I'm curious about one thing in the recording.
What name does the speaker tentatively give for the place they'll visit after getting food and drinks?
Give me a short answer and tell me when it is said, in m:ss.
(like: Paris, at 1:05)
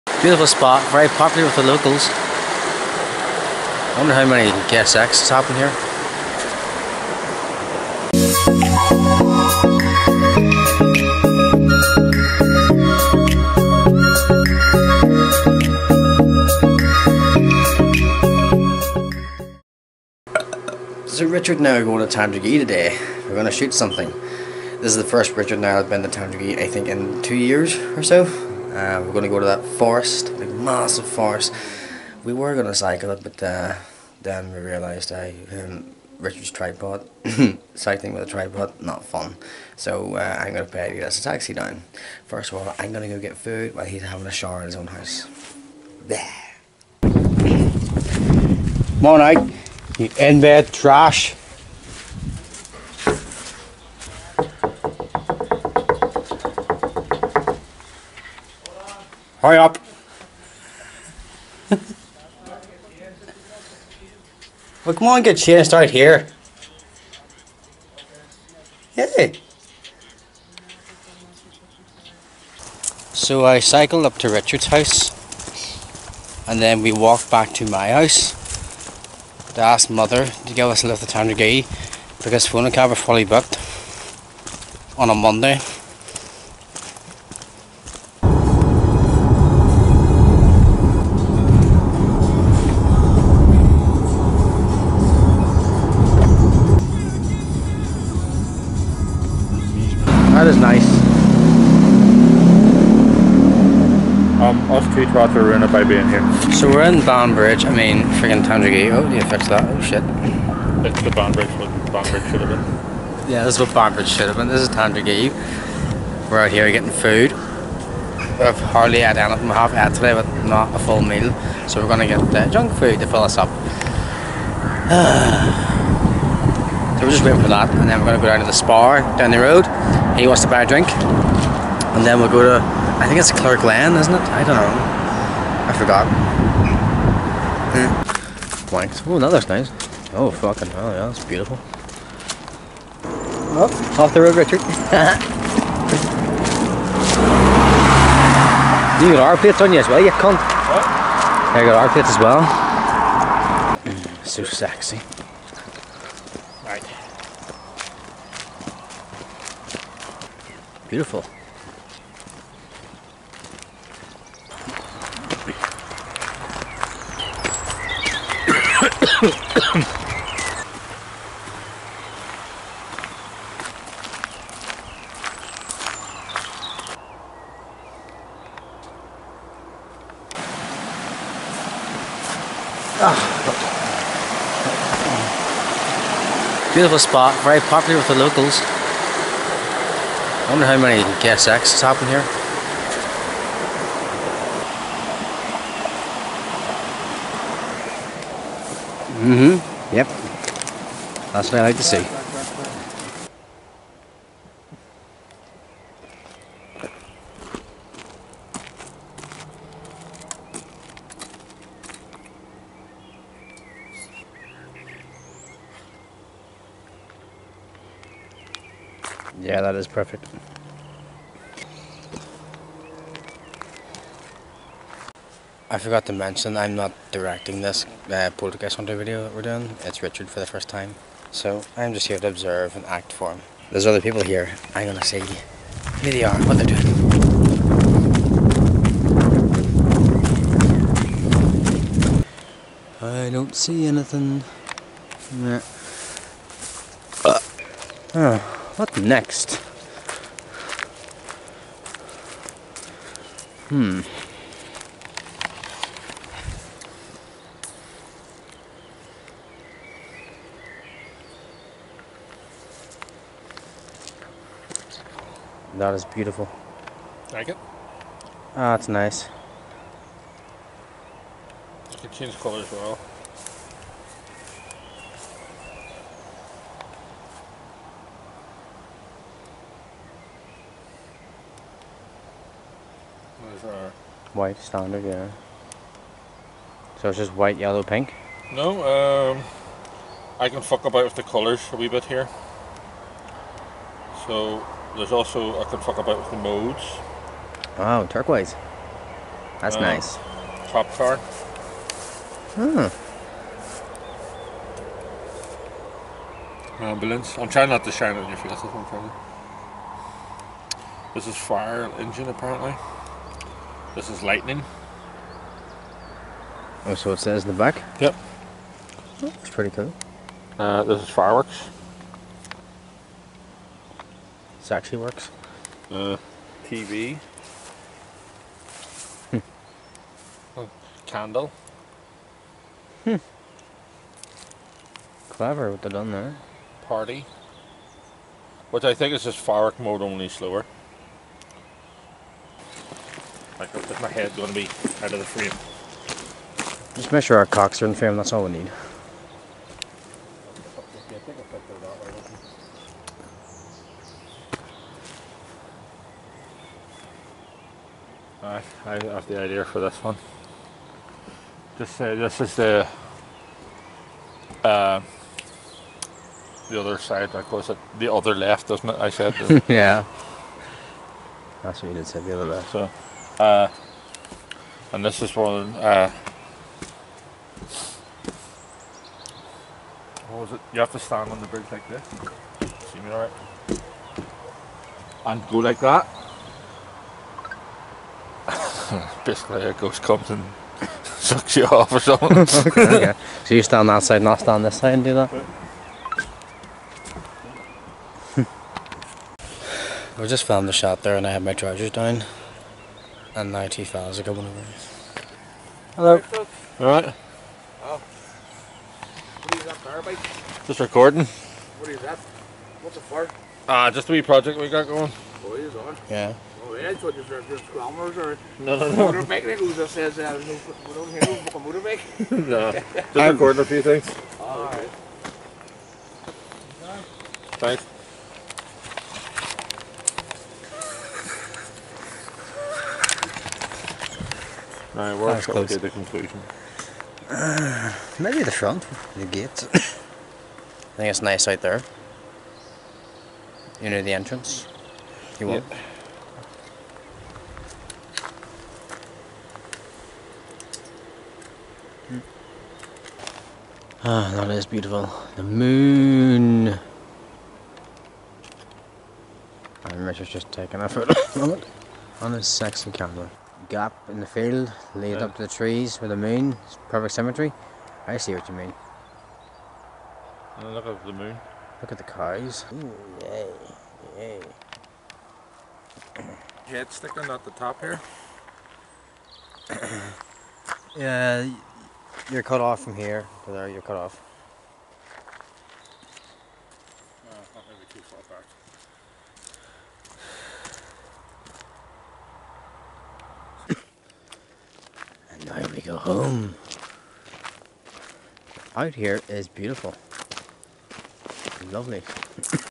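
Clare Glen, at 2:13.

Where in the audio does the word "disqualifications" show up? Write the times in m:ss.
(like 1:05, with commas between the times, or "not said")
not said.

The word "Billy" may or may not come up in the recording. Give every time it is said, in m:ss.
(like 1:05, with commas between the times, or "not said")
not said.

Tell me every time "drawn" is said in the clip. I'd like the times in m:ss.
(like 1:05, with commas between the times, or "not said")
not said.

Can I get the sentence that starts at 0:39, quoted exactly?
So uh, I'm going to pay you as a taxi down.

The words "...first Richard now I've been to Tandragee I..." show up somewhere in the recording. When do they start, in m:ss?
0:25.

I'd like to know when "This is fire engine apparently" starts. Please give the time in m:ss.
5:11.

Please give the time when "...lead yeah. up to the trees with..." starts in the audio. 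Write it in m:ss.
7:44.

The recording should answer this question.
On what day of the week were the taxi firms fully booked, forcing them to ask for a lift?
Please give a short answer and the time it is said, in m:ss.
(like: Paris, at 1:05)
Monday, at 1:25.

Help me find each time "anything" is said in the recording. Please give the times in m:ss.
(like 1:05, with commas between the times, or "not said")
1:59, 4:03.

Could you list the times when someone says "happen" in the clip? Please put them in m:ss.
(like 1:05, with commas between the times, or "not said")
0:05.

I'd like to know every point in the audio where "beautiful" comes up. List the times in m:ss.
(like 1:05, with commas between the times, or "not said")
0:00, 2:21, 2:40, 3:06, 4:26, 7:34, 8:19.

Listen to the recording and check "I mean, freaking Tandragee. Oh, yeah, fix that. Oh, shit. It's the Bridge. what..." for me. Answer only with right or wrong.
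right.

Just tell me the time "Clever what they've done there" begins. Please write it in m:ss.
5:35.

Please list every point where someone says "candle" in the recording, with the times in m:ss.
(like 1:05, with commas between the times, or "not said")
5:31.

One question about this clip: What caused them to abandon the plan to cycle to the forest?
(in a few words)
Richard's tripod.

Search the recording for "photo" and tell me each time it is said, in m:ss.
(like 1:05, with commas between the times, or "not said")
7:40.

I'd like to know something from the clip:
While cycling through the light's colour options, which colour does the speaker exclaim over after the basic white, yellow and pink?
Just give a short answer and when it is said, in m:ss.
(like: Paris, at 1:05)
turquoise, at 4:58.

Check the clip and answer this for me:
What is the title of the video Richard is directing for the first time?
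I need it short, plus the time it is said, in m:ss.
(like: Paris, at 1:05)
Poltergeist Hunter, at 3:48.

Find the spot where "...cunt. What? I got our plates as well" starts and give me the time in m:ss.
2:30.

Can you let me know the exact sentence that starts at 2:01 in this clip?
So we're going to get uh, junk food to fill us up.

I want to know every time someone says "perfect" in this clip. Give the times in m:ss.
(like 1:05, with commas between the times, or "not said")
3:39, 7:46.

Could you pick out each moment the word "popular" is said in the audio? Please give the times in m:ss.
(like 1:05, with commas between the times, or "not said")
0:01, 3:07.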